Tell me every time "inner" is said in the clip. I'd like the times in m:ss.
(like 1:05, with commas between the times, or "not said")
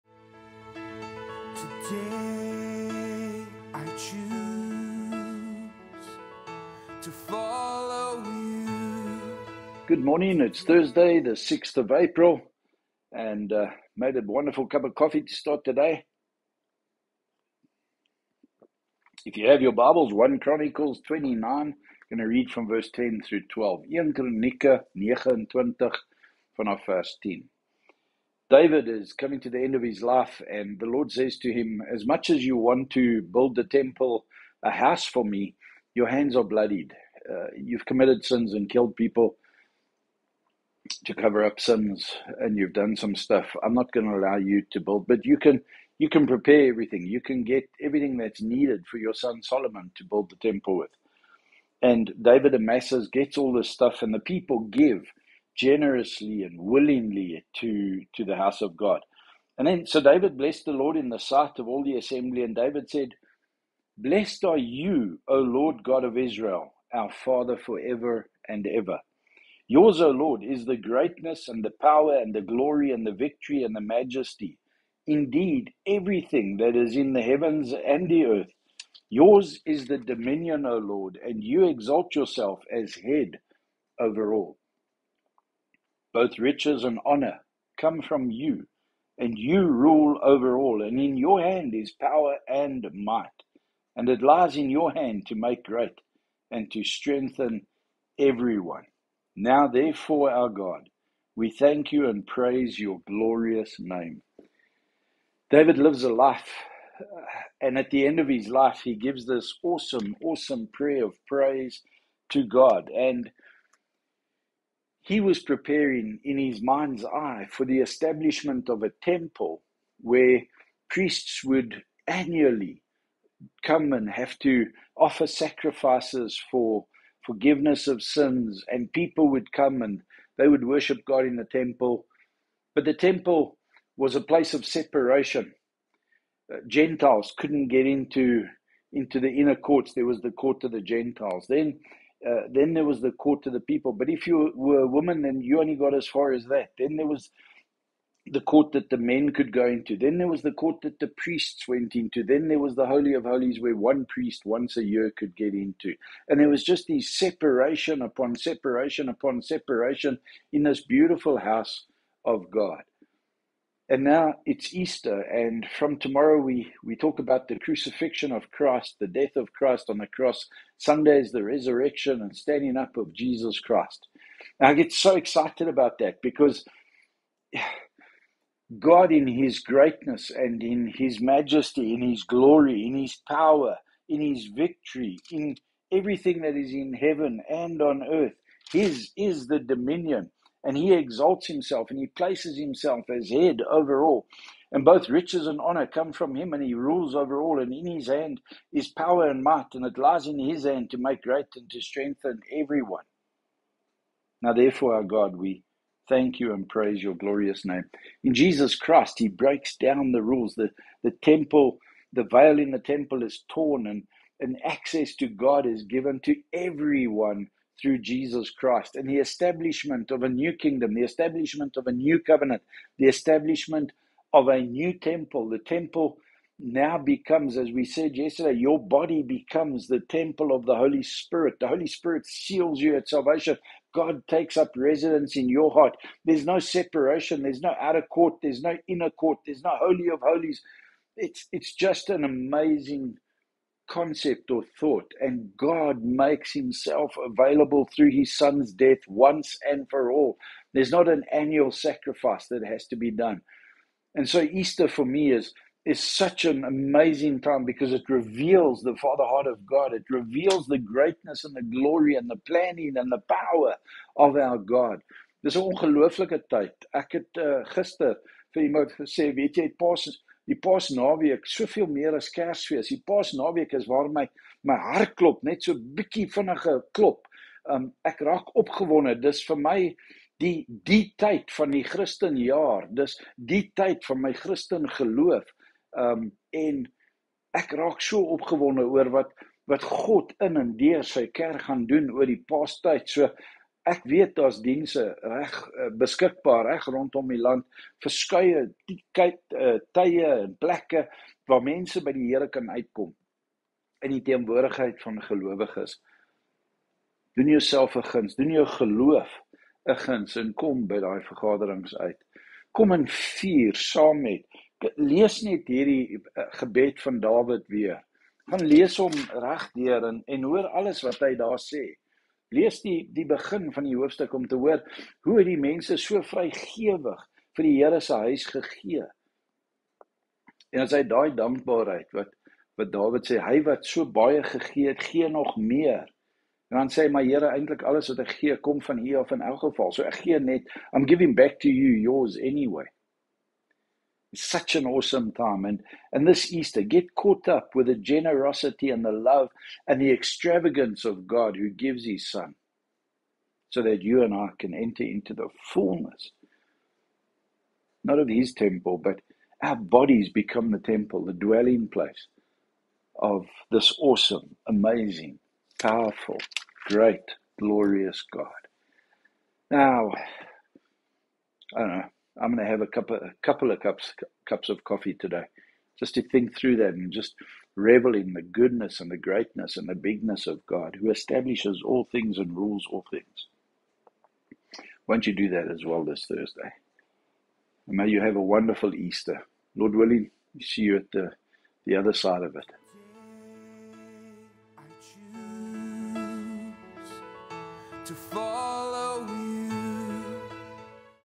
2:19, 3:58.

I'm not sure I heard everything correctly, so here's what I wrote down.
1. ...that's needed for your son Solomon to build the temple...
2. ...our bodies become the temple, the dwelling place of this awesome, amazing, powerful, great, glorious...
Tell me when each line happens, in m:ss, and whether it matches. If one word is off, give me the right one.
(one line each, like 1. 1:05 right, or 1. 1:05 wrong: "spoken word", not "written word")
1. 0:48 right
2. 5:59 right.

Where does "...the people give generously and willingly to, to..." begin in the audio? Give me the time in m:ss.
0:54.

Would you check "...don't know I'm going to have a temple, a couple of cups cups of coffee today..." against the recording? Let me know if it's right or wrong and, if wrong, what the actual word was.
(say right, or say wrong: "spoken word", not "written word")
wrong: "couple", not "temple".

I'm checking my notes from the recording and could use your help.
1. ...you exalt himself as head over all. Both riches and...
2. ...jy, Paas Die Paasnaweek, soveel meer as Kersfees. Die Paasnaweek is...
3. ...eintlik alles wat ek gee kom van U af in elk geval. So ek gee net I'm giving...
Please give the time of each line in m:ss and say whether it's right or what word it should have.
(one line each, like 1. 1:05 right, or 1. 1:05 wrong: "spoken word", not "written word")
1. 1:21 wrong: "yourself", not "himself"
2. 4:29 right
3. 5:37 right.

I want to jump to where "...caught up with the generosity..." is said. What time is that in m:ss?
5:47.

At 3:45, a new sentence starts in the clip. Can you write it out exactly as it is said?
The temple now becomes, as we said yesterday, your body becomes the temple of the Holy Spirit.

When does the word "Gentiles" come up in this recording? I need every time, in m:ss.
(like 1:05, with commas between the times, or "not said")
2:16, 2:20.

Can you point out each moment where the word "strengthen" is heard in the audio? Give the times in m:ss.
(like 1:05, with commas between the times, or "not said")
1:36, 3:21.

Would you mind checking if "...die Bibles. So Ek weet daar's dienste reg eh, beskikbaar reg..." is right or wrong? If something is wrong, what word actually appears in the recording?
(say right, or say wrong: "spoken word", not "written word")
wrong: "Paastyd", not "Bibles".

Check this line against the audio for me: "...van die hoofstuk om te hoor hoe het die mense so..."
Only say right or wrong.
right.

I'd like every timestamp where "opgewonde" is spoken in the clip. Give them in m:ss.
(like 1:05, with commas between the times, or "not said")
4:38, 4:48.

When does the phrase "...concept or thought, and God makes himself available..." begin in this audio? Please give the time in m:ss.
4:03.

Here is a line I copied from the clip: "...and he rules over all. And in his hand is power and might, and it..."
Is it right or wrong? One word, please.
right.